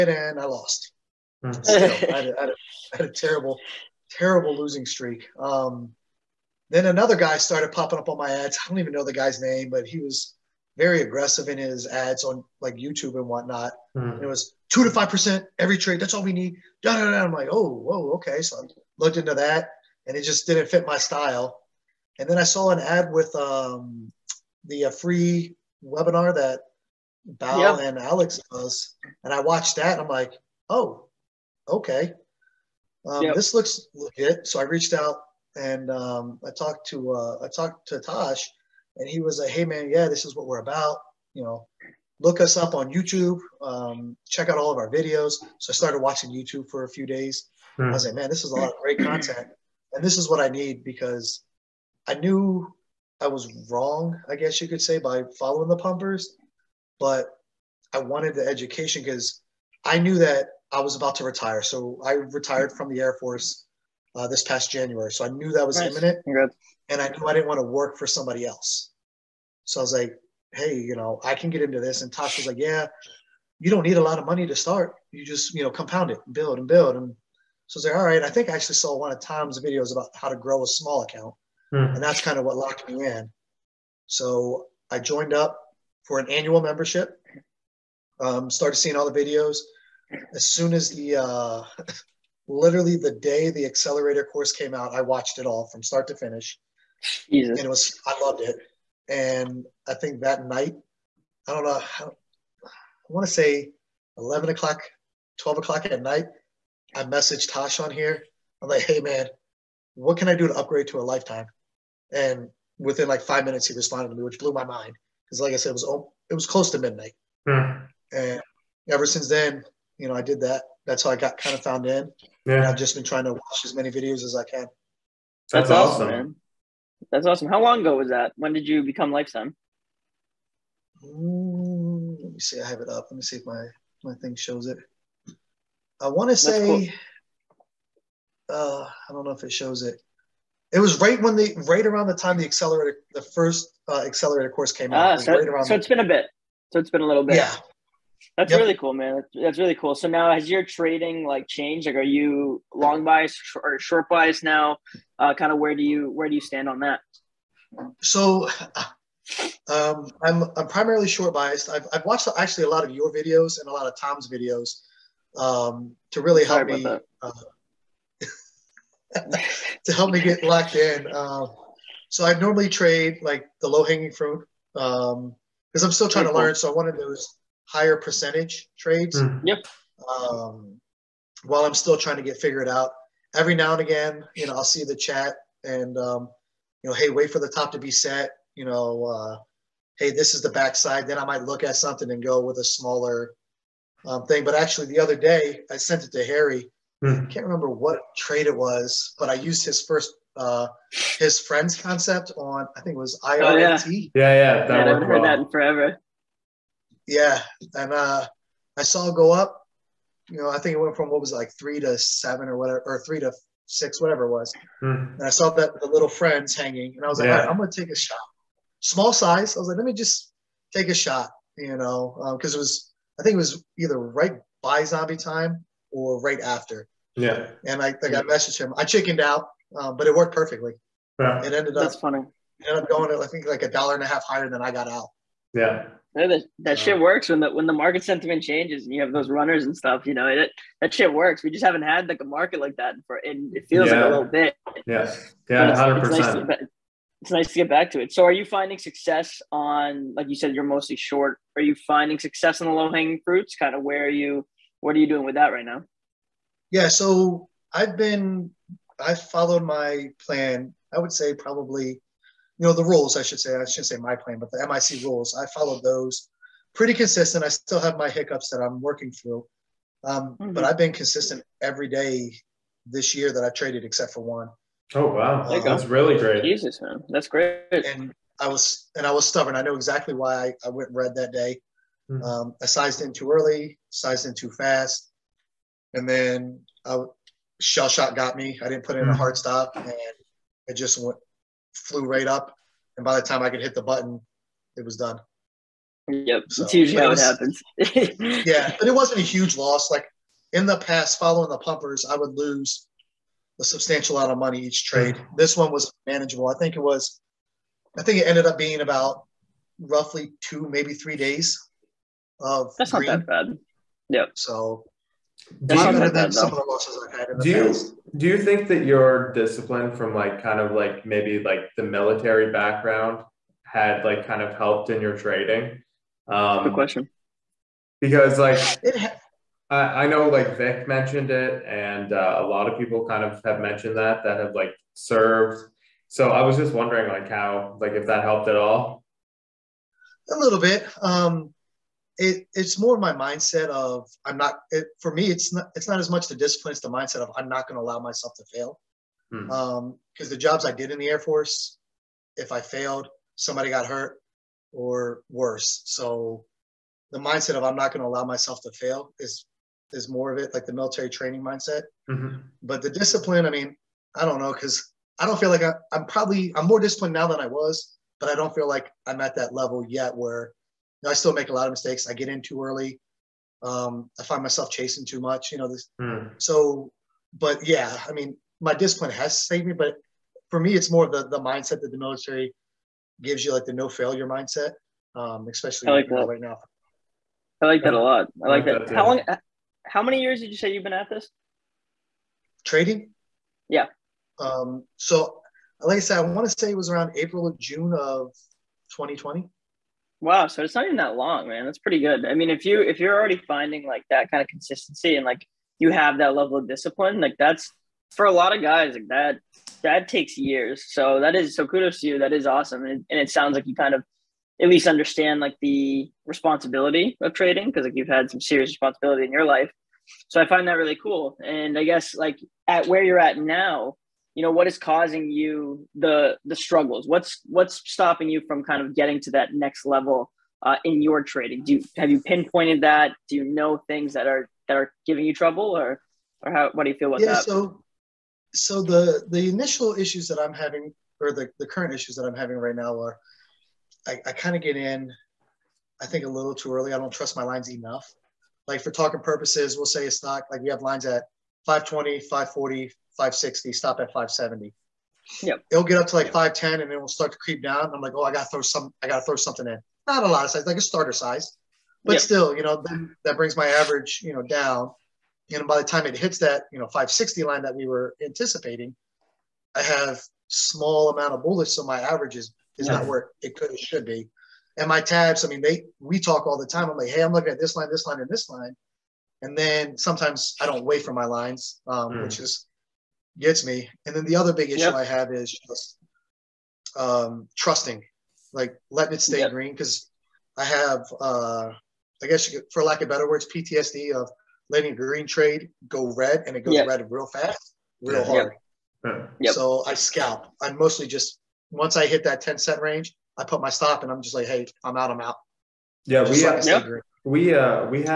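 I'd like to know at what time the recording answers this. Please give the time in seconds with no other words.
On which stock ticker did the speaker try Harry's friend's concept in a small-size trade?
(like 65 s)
203 s.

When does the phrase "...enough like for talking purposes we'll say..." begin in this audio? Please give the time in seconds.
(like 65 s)
447 s.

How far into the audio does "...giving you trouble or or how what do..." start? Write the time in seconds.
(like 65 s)
435 s.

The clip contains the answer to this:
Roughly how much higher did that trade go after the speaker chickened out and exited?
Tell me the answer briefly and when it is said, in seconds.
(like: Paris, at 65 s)
a dollar and a half, at 233 s.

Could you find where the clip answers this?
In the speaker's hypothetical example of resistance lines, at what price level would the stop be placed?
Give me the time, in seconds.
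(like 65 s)
454 s.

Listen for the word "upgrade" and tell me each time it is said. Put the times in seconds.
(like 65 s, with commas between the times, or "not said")
110 s.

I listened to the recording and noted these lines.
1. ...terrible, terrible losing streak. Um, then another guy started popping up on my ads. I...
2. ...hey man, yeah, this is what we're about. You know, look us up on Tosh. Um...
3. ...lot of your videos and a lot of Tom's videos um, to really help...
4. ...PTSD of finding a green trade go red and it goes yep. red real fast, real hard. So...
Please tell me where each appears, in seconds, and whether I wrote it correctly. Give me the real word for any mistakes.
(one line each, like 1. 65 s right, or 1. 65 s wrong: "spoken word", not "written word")
1. 3 s right
2. 39 s wrong: "YouTube", not "Tosh"
3. 162 s right
4. 493 s wrong: "letting", not "finding".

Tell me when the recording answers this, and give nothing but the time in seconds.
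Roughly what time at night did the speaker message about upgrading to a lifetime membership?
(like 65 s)
104 s.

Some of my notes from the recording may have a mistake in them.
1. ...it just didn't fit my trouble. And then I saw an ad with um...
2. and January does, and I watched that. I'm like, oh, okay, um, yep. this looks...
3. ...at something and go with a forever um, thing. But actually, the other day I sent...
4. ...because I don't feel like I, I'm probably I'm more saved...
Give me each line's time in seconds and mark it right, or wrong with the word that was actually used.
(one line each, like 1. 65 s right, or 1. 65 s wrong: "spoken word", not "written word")
1. 20 s wrong: "style", not "trouble"
2. 27 s wrong: "Alex", not "January"
3. 191 s wrong: "smaller", not "forever"
4. 364 s wrong: "disciplined", not "saved".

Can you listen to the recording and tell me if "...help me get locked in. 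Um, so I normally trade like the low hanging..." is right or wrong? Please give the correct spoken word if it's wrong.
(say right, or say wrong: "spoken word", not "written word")
right.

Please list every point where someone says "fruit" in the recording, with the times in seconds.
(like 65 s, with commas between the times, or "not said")
174 s, 253 s.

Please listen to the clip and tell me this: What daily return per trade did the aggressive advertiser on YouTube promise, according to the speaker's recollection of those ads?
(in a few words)
2 to 5 percent.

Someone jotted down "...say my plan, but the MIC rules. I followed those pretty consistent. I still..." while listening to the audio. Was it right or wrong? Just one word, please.
right.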